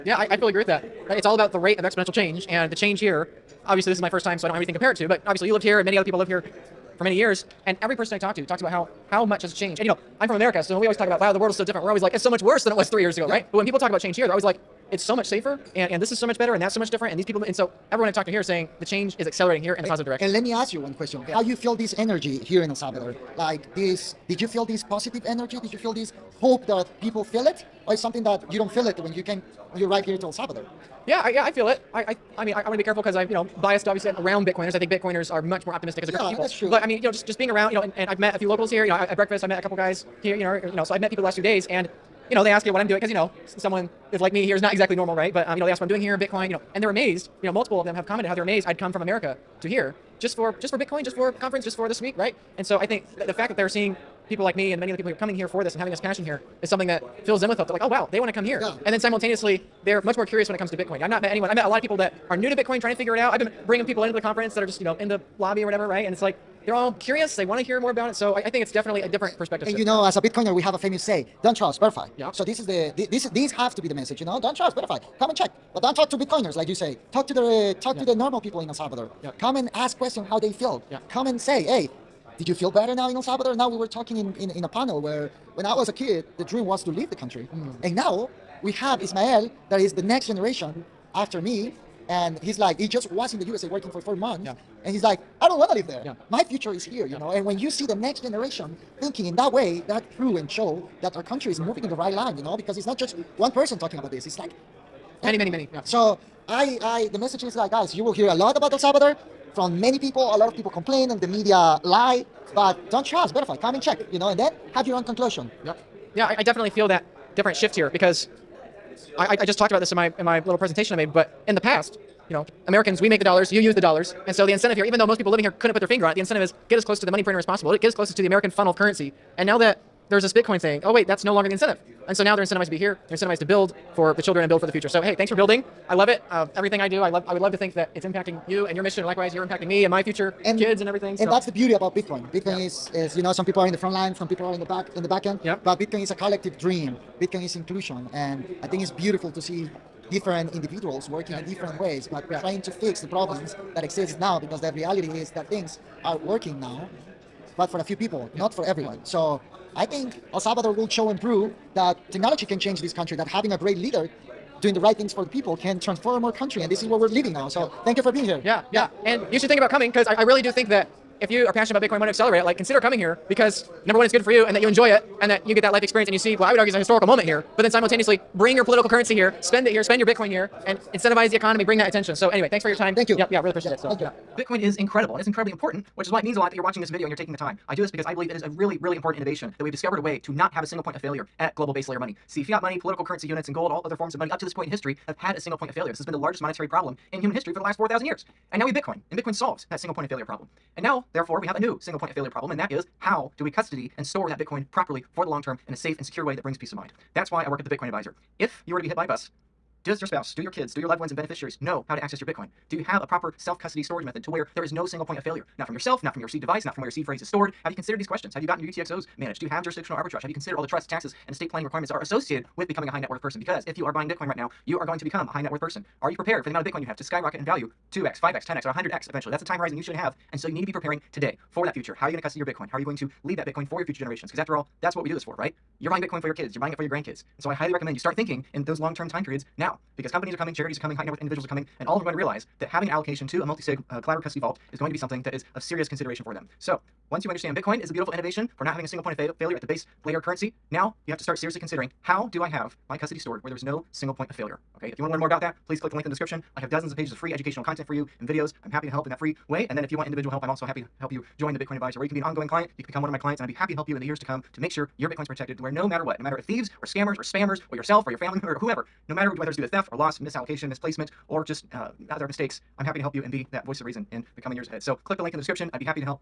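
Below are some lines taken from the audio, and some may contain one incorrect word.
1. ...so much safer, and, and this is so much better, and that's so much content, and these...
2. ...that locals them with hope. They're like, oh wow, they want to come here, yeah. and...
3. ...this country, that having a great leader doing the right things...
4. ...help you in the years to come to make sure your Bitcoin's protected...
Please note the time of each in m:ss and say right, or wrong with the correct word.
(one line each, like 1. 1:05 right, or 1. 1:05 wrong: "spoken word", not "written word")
1. 0:15 wrong: "different", not "content"
2. 0:56 wrong: "fills", not "locals"
3. 2:42 right
4. 4:23 right.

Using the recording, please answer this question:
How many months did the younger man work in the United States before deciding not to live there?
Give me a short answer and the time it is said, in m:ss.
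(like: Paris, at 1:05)
4, at 1:33.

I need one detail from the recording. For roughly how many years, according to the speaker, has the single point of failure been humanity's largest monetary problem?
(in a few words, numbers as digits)
4,000.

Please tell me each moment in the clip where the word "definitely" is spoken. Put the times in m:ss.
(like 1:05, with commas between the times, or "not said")
1:08, 1:56.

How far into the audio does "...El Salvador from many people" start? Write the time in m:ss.
1:48.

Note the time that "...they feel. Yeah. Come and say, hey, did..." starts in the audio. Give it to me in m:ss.
1:20.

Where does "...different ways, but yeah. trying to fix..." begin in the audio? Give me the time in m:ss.
2:31.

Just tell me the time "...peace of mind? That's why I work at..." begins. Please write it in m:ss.
3:26.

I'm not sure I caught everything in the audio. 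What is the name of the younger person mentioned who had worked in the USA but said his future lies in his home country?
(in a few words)
Ismael.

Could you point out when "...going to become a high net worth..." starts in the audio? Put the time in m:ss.
3:44.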